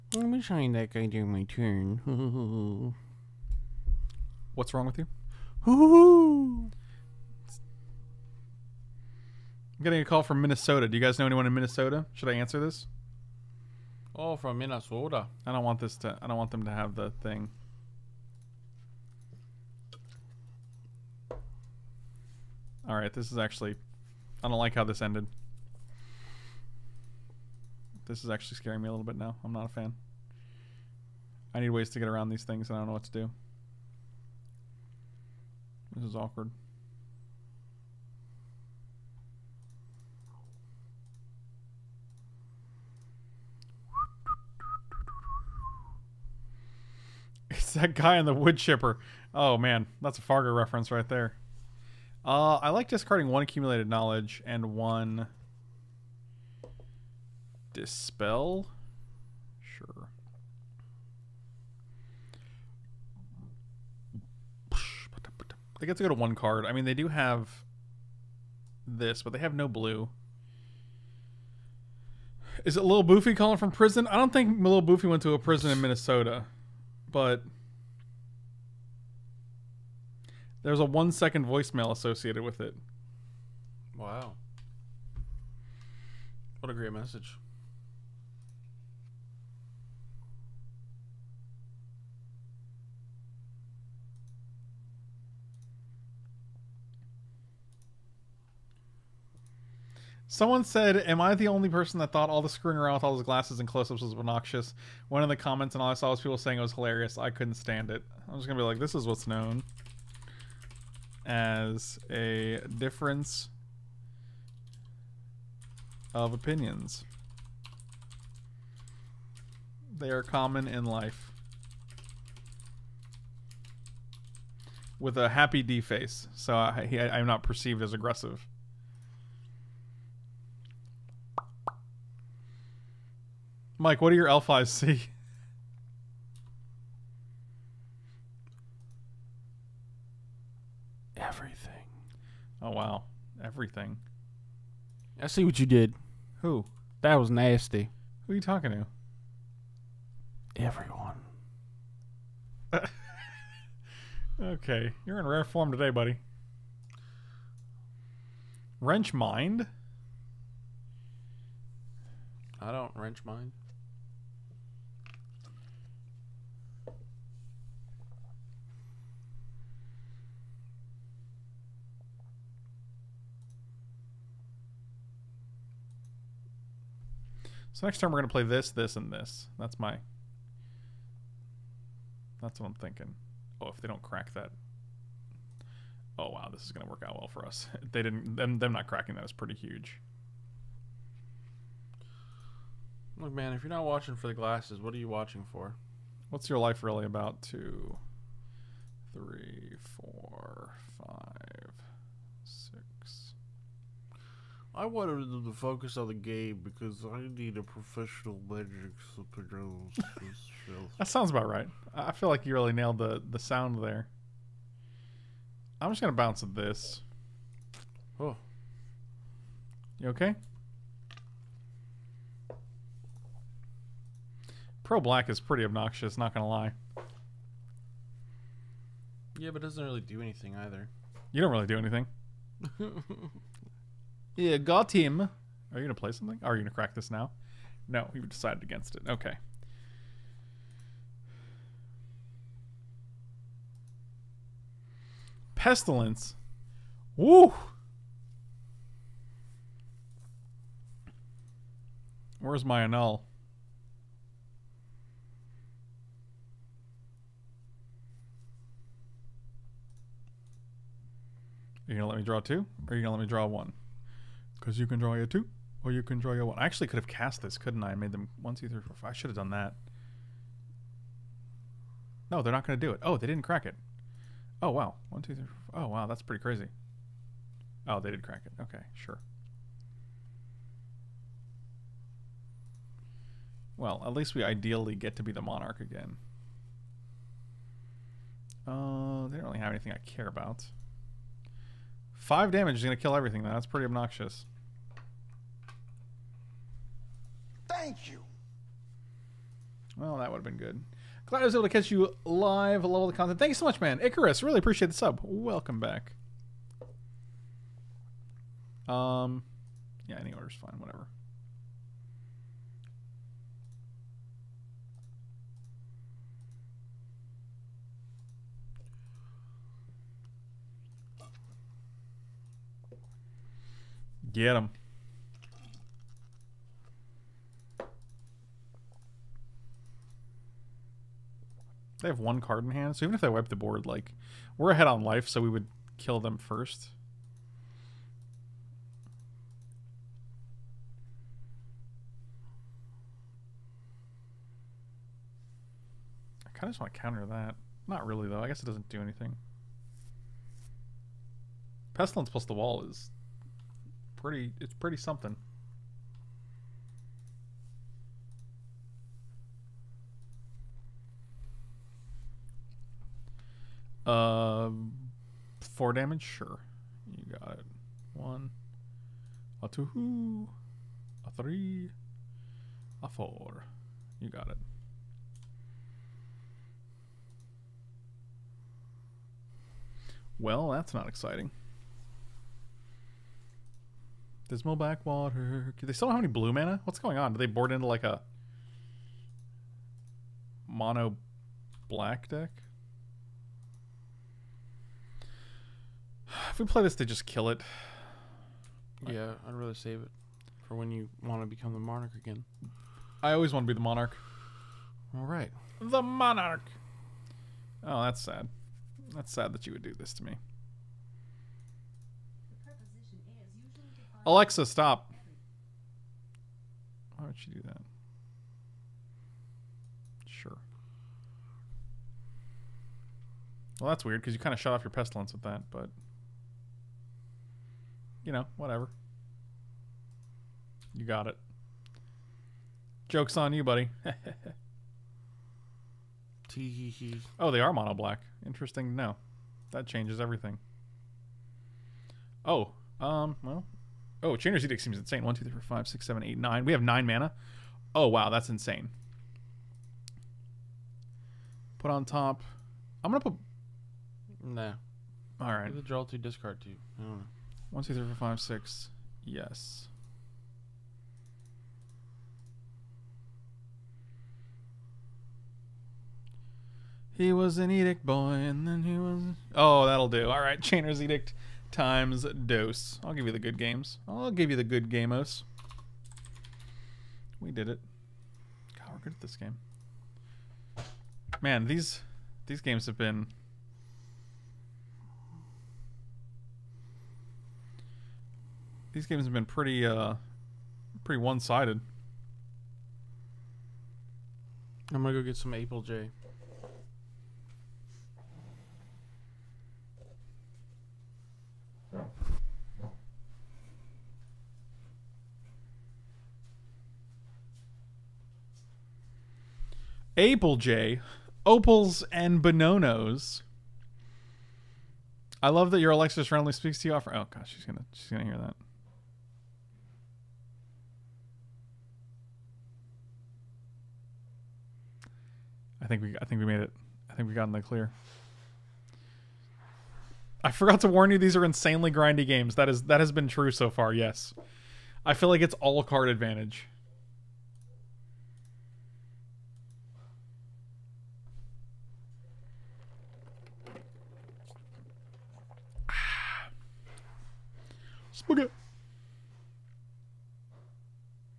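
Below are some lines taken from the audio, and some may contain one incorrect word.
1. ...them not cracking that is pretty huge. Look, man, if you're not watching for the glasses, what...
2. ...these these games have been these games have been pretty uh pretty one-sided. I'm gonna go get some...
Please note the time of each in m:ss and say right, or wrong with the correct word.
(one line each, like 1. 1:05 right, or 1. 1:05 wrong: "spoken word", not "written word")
1. 3:08 right
2. 8:01 right.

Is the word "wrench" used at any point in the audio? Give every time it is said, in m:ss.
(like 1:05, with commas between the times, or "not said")
2:38, 2:42.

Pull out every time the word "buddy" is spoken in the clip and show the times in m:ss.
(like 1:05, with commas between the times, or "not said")
2:35, 7:13.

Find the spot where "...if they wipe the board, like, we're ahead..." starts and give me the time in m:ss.
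5:33.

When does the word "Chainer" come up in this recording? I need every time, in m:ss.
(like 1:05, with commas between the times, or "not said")
7:24, 7:50.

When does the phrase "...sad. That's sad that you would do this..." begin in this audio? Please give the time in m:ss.
6:48.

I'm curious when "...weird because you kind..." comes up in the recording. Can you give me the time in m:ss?
7:04.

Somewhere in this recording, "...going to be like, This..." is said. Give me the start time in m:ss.
1:48.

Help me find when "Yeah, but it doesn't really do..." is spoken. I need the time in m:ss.
3:49.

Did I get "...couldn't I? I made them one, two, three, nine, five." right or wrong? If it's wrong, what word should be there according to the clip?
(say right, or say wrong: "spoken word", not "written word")
wrong: "four", not "nine".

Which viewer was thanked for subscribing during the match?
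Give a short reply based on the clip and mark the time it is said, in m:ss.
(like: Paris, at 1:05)
Icarus, at 5:04.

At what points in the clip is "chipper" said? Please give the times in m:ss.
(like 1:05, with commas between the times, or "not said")
0:48.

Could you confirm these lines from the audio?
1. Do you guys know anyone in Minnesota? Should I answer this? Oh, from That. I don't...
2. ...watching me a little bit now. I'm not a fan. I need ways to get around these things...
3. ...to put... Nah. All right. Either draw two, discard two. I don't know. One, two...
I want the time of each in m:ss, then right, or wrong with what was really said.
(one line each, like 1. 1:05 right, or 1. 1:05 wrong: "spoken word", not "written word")
1. 0:10 wrong: "Minnesota", not "That"
2. 0:28 wrong: "scaring", not "watching"
3. 7:33 right.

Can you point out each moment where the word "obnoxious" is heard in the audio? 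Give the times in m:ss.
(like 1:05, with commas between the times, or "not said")
1:44, 3:45, 4:53.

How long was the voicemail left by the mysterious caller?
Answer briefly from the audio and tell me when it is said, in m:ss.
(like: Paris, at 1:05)
1 second, at 1:20.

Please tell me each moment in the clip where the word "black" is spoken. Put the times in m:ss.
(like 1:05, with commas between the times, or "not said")
3:45, 6:31, 7:17.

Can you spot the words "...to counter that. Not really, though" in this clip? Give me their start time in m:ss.
5:46.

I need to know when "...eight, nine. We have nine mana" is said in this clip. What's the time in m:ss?
7:26.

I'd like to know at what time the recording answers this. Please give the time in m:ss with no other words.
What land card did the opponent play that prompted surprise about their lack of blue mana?
6:24.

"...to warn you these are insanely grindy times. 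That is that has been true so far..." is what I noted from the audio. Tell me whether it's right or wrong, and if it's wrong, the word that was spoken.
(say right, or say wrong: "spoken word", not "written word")
wrong: "games", not "times".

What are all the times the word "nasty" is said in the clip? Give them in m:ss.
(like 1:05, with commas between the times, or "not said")
2:27.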